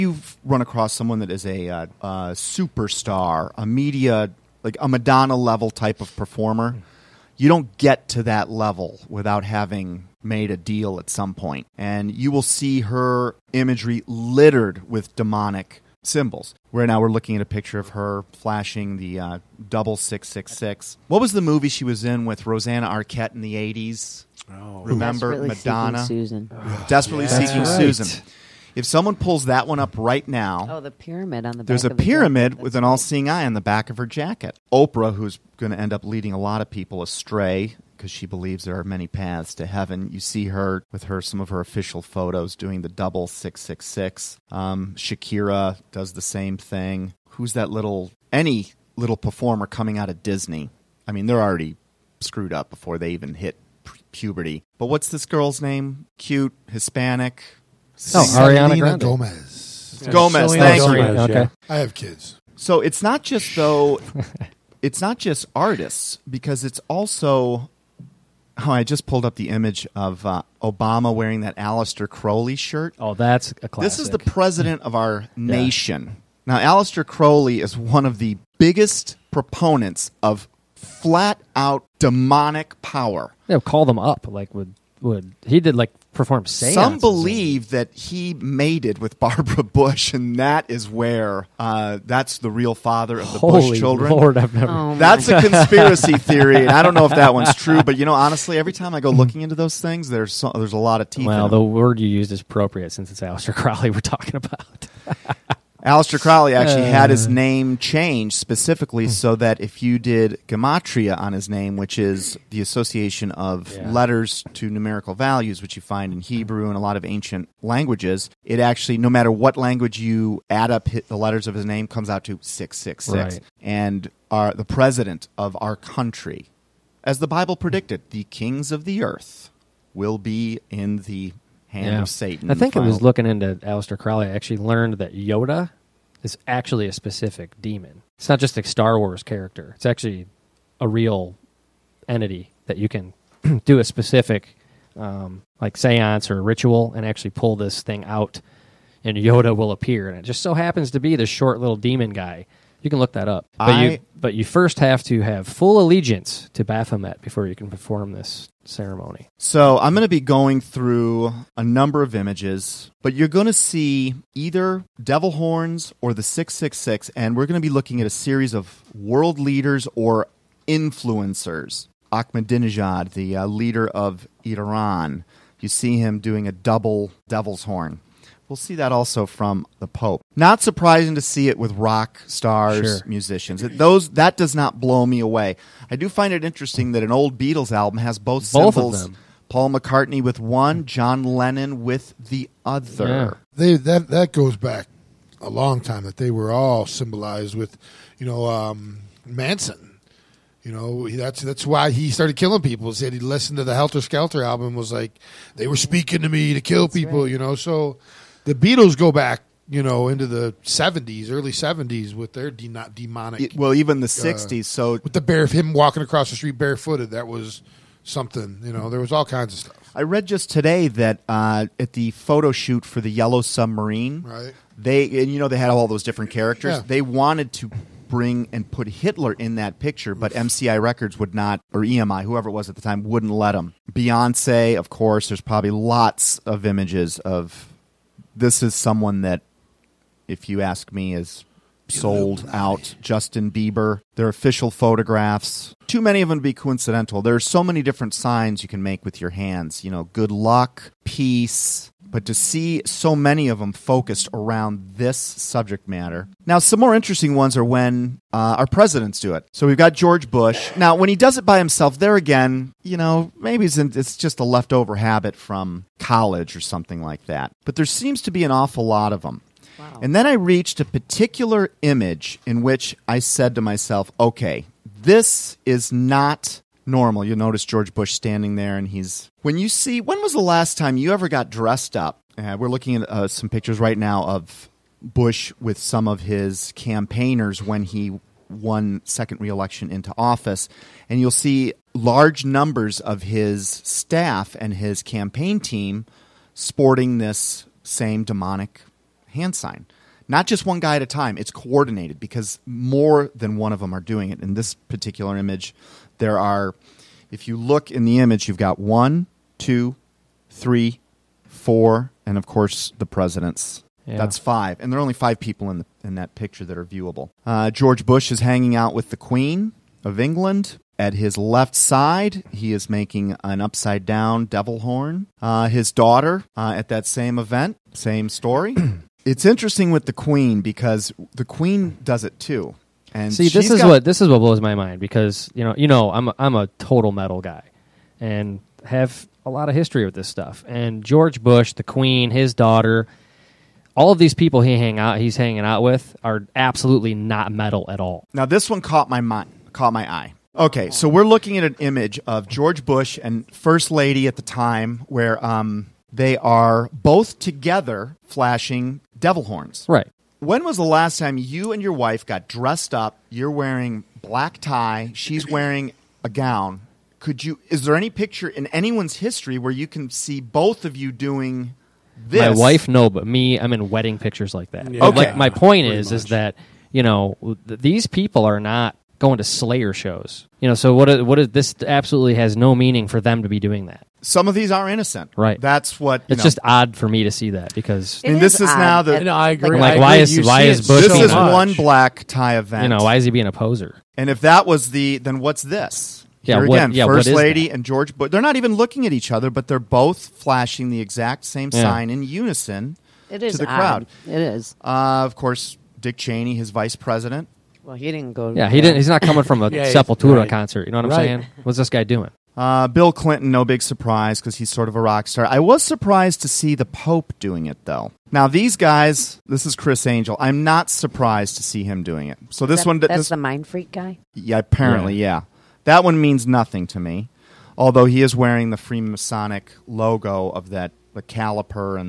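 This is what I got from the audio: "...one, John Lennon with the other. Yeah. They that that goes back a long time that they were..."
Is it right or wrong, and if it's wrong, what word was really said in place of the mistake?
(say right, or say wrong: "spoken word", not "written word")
right.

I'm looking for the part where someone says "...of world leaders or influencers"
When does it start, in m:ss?
2:48.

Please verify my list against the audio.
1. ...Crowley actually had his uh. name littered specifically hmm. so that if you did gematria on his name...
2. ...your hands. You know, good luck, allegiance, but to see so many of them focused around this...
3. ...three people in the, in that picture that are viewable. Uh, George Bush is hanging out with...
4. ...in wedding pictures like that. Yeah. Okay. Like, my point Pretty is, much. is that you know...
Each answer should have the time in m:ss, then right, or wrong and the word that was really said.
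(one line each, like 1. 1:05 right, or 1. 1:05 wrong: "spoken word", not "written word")
1. 1:46 wrong: "changed", not "littered"
2. 4:09 wrong: "peace", not "allegiance"
3. 5:15 wrong: "five", not "three"
4. 6:13 right.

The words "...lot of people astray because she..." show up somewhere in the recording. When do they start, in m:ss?
0:36.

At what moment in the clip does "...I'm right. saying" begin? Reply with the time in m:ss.
6:51.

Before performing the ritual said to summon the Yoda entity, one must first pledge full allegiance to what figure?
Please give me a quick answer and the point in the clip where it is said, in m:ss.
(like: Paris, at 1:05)
Baphomet, at 2:36.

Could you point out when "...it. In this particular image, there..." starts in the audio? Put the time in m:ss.
5:04.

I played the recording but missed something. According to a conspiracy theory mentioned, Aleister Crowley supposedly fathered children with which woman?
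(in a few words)
Barbara Bush.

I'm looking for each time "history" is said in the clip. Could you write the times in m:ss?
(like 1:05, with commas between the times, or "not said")
5:39, 6:09.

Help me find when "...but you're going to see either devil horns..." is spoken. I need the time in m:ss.
2:43.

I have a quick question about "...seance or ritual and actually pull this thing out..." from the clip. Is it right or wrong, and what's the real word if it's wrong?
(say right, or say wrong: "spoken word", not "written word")
right.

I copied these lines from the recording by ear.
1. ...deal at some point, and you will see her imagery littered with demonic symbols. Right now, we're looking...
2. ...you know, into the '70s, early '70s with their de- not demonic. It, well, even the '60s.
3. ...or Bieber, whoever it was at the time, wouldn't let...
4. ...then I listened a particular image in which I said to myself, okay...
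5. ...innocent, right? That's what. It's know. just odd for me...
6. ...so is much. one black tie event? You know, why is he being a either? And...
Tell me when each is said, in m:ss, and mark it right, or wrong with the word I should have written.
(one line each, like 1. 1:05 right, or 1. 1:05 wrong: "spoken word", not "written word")
1. 0:10 right
2. 3:29 right
3. 3:51 wrong: "EMI", not "Bieber"
4. 4:30 wrong: "reached", not "listened"
5. 6:24 right
6. 6:31 wrong: "poser", not "either".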